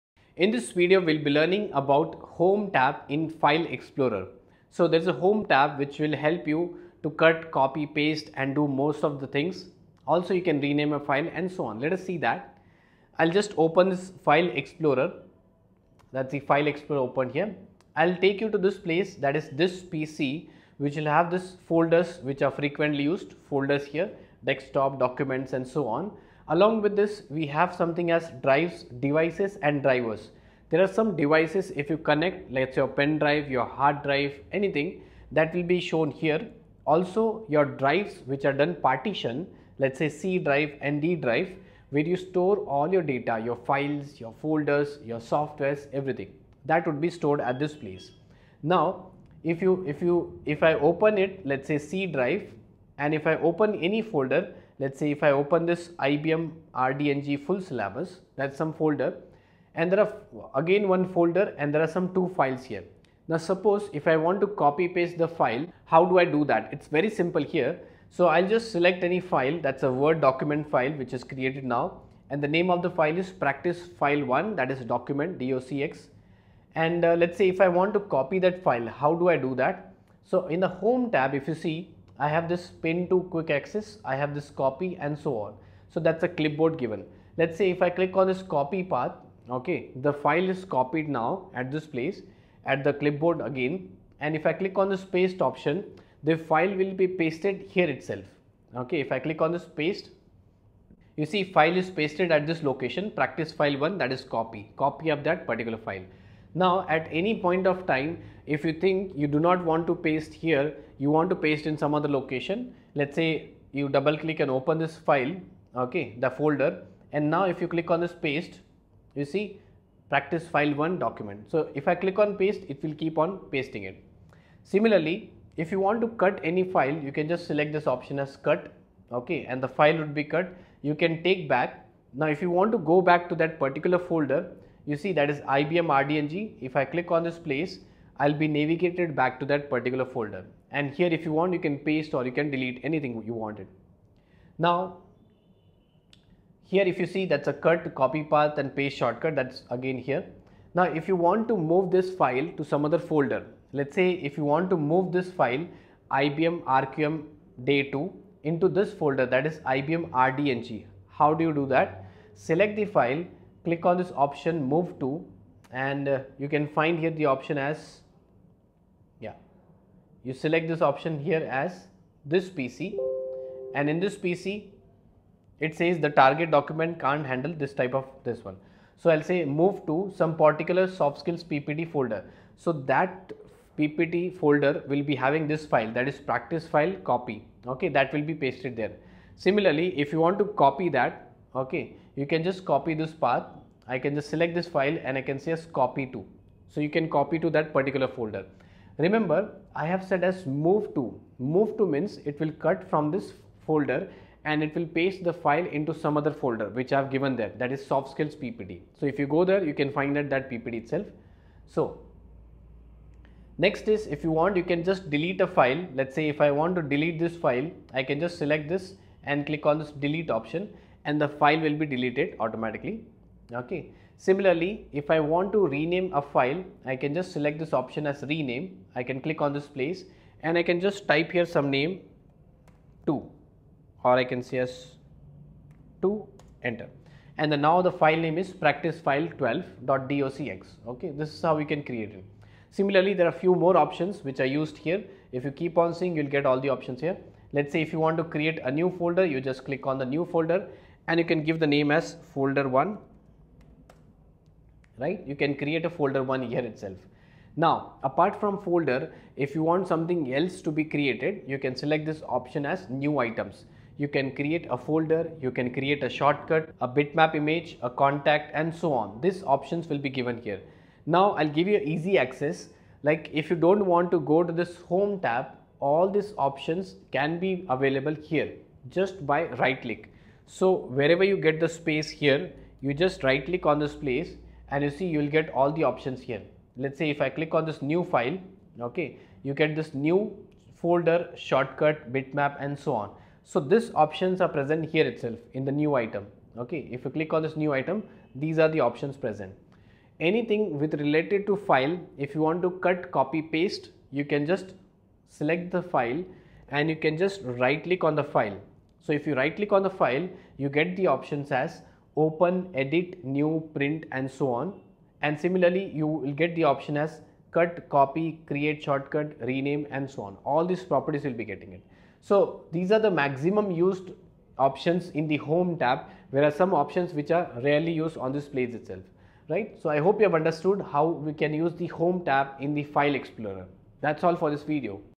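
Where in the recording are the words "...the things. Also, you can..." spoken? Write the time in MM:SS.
00:09.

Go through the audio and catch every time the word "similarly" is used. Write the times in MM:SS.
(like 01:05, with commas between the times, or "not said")
02:04, 03:09, 03:44, 04:02, 05:15.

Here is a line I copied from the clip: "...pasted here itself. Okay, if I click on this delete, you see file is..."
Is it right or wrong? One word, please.
wrong.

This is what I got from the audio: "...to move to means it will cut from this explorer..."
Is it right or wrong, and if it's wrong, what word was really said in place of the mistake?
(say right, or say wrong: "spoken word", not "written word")
wrong: "folder", not "explorer".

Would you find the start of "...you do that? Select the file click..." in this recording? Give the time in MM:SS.
02:41.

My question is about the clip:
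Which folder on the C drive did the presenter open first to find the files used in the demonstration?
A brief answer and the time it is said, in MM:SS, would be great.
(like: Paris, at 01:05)
IBM RDNG full syllabus, at 00:55.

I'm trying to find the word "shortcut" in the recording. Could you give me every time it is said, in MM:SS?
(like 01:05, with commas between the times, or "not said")
02:28, 04:26, 04:51, 05:18.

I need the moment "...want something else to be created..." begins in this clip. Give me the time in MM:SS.
04:19.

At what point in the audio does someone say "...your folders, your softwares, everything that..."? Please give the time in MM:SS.
00:44.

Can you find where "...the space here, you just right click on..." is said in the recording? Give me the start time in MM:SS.
04:41.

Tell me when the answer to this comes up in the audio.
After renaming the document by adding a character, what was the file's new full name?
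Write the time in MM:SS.
03:58.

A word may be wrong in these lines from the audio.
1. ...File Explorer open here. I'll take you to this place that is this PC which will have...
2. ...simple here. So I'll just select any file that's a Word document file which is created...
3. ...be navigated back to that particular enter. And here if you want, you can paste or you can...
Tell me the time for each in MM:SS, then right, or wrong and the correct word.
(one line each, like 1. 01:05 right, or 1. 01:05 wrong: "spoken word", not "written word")
1. 00:16 right
2. 01:07 right
3. 02:18 wrong: "folder", not "enter".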